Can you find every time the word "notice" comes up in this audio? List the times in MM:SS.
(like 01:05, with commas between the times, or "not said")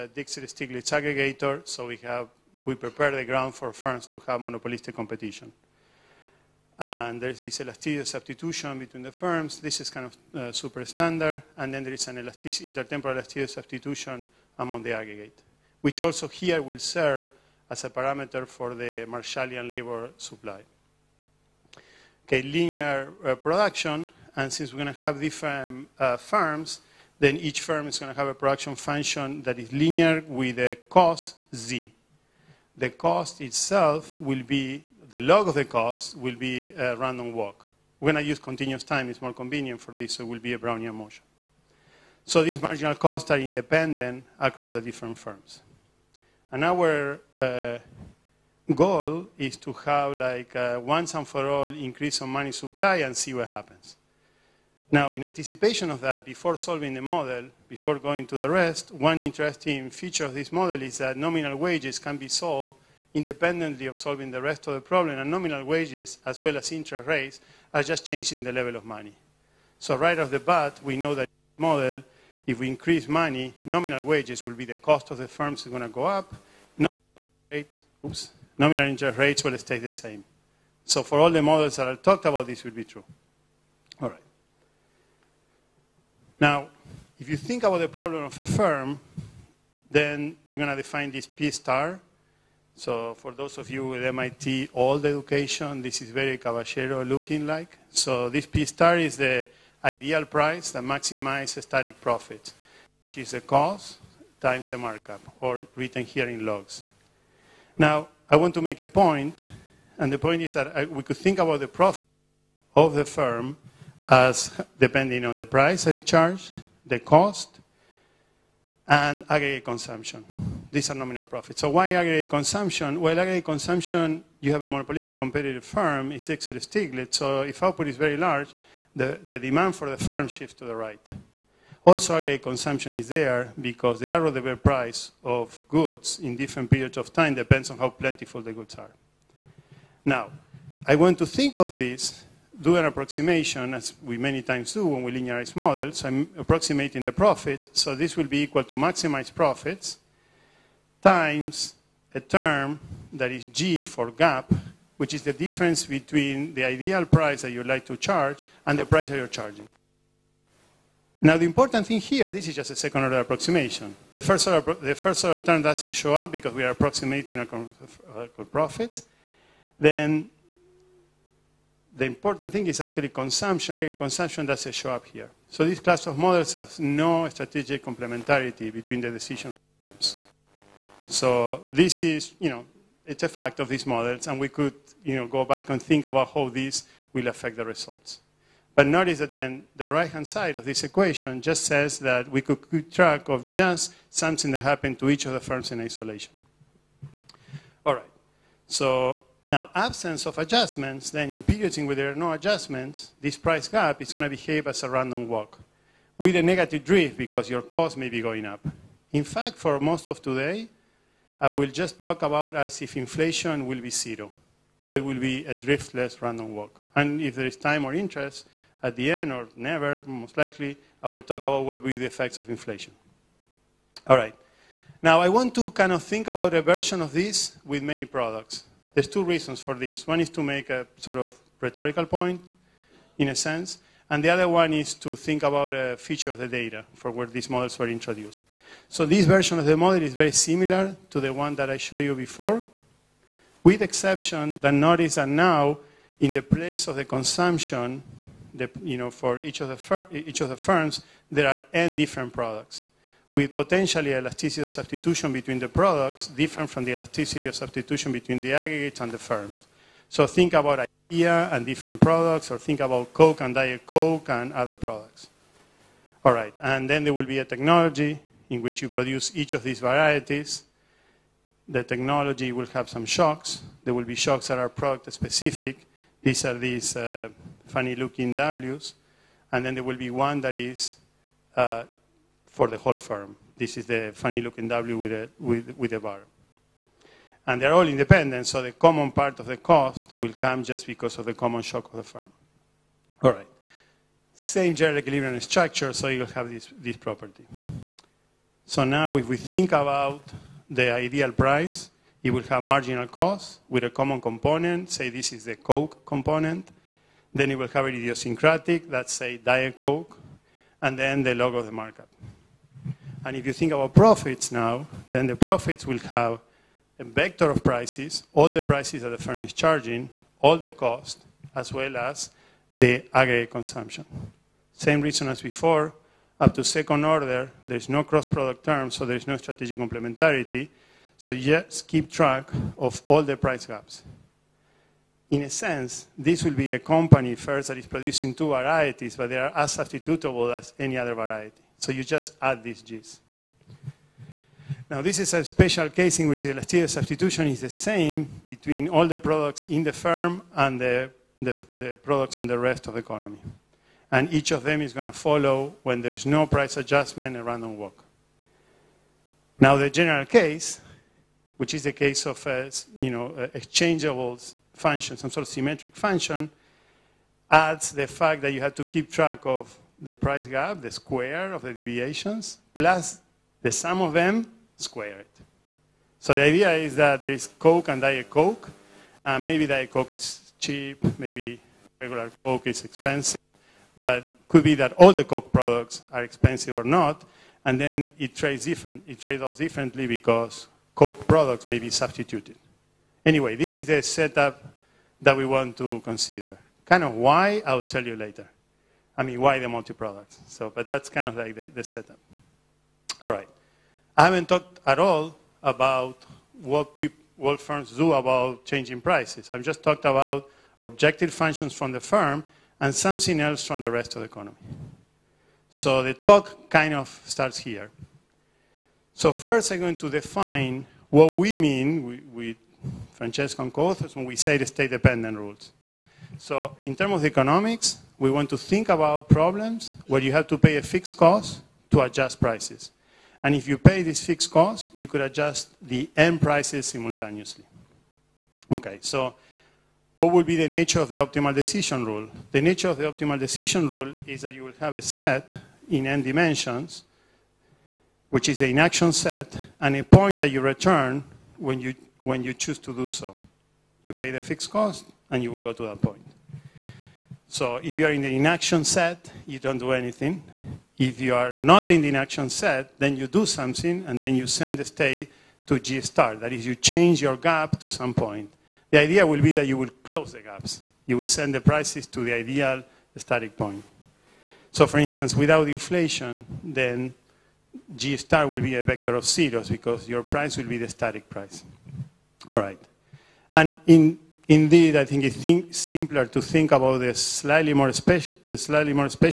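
03:08, 04:04.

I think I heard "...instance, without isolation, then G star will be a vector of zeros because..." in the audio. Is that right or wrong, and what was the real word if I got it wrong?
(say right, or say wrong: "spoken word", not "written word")
wrong: "inflation", not "isolation".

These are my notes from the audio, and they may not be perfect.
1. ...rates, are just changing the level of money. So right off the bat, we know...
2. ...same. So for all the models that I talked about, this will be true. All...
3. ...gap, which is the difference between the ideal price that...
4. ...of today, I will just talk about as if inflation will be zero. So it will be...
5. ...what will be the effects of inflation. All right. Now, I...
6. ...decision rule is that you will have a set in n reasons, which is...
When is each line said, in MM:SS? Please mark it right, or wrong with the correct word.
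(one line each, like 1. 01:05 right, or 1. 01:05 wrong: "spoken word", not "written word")
1. 01:07 right
2. 01:19 right
3. 02:34 right
4. 03:30 right
5. 03:41 right
6. 07:23 wrong: "dimensions", not "reasons".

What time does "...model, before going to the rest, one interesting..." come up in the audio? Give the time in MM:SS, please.
00:57.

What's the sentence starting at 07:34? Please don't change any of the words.
You pay the fixed cost, and you will go to that point.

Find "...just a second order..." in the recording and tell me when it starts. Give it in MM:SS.
02:42.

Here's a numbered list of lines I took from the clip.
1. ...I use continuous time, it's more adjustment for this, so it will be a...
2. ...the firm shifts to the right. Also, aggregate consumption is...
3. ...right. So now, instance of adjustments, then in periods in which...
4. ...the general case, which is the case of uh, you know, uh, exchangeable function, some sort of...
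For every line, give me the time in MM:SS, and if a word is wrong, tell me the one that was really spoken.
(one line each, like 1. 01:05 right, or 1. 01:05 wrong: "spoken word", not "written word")
1. 00:38 wrong: "convenient", not "adjustment"
2. 02:09 right
3. 03:17 wrong: "absence", not "instance"
4. 05:59 right.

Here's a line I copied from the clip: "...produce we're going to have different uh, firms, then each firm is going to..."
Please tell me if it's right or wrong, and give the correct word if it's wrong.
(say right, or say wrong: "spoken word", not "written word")
wrong: "since", not "produce".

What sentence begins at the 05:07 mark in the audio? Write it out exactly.
Then it will have an idiosyncratic, that's say Diet Coke, and then the log of the markup.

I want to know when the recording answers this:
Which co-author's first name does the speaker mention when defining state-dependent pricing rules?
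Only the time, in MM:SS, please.
07:03.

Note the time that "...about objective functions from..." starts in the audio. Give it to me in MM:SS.
06:50.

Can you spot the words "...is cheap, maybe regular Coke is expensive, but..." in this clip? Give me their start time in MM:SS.
06:20.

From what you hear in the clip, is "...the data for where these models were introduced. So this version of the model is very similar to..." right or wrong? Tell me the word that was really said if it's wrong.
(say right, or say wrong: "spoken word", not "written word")
right.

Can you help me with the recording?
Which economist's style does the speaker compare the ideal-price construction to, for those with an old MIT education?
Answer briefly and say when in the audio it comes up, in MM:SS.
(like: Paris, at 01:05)
Caballero, at 01:36.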